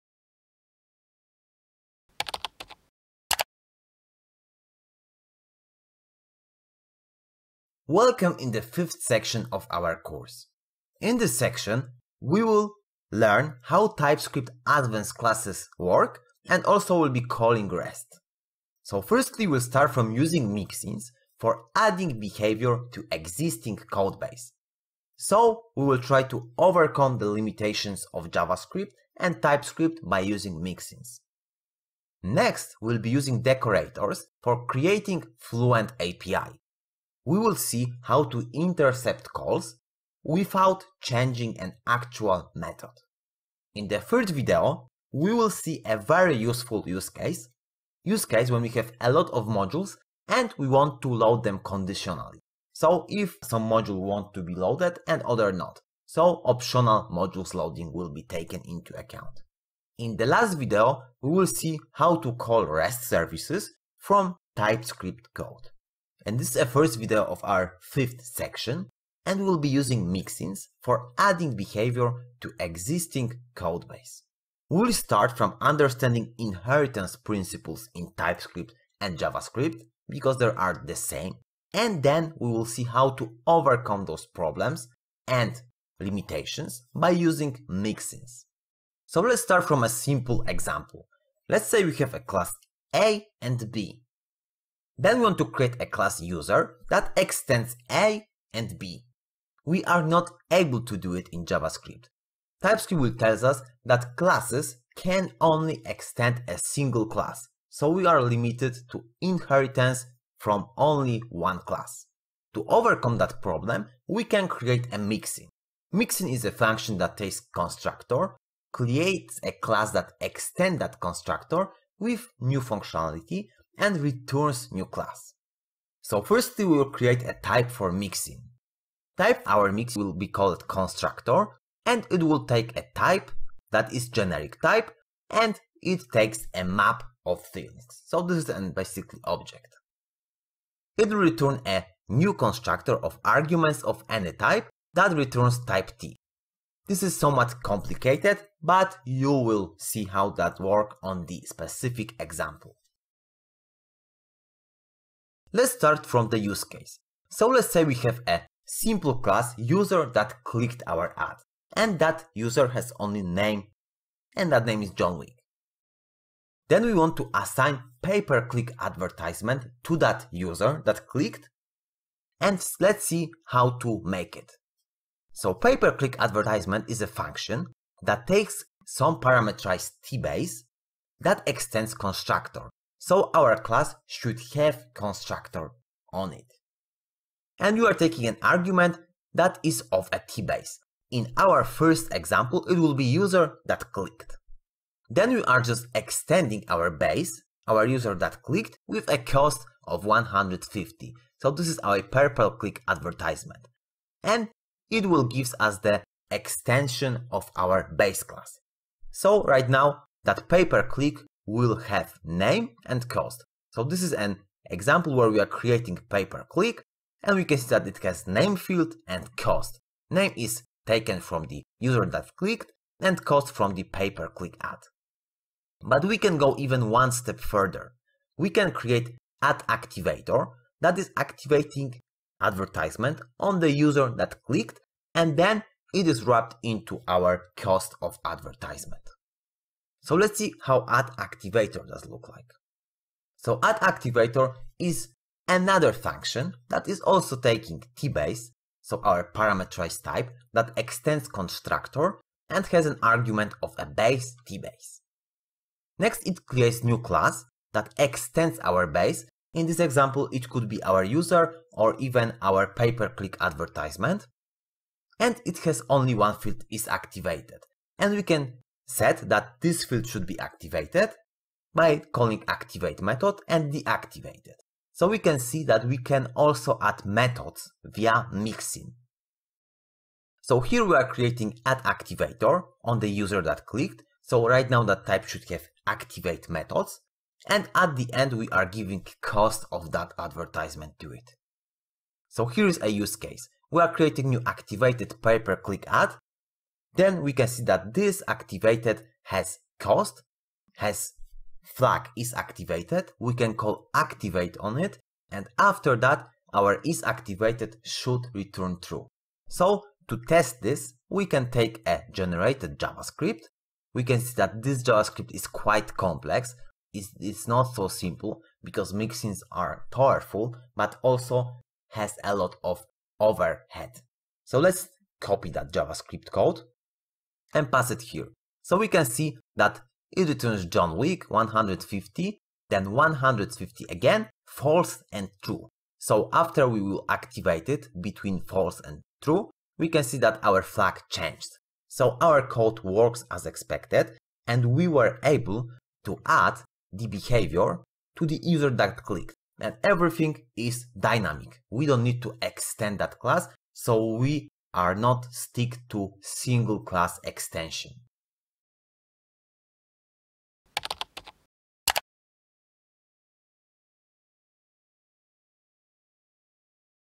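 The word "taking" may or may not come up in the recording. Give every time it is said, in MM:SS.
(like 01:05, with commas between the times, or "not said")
03:07, 04:07.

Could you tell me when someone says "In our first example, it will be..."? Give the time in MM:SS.
03:11.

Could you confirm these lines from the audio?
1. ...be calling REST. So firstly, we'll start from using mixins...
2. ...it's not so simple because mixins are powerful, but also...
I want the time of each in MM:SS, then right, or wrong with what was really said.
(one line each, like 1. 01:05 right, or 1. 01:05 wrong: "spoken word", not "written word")
1. 00:17 right
2. 05:17 right.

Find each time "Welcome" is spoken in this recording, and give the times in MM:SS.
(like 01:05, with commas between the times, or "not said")
00:07.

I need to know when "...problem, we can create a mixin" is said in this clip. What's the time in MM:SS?
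01:53.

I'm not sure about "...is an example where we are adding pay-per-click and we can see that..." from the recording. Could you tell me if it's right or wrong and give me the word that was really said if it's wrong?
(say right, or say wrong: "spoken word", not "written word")
wrong: "creating", not "adding".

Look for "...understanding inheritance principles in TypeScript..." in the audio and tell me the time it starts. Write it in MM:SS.
01:15.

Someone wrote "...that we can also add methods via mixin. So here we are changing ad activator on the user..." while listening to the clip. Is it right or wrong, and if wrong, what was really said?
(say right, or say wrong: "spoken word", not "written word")
wrong: "creating", not "changing".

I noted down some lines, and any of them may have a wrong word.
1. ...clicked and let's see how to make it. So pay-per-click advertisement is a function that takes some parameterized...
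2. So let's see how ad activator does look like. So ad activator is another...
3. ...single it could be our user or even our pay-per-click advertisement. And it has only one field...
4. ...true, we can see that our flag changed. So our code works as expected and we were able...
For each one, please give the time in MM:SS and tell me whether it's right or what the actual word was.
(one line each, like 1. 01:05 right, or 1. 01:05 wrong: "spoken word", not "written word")
1. 02:51 right
2. 04:00 right
3. 04:19 wrong: "example", not "single"
4. 05:39 right.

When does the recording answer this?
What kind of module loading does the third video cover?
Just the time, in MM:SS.
00:56.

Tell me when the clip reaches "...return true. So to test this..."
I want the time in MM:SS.
05:08.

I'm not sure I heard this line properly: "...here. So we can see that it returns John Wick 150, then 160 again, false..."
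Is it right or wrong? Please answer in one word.
wrong.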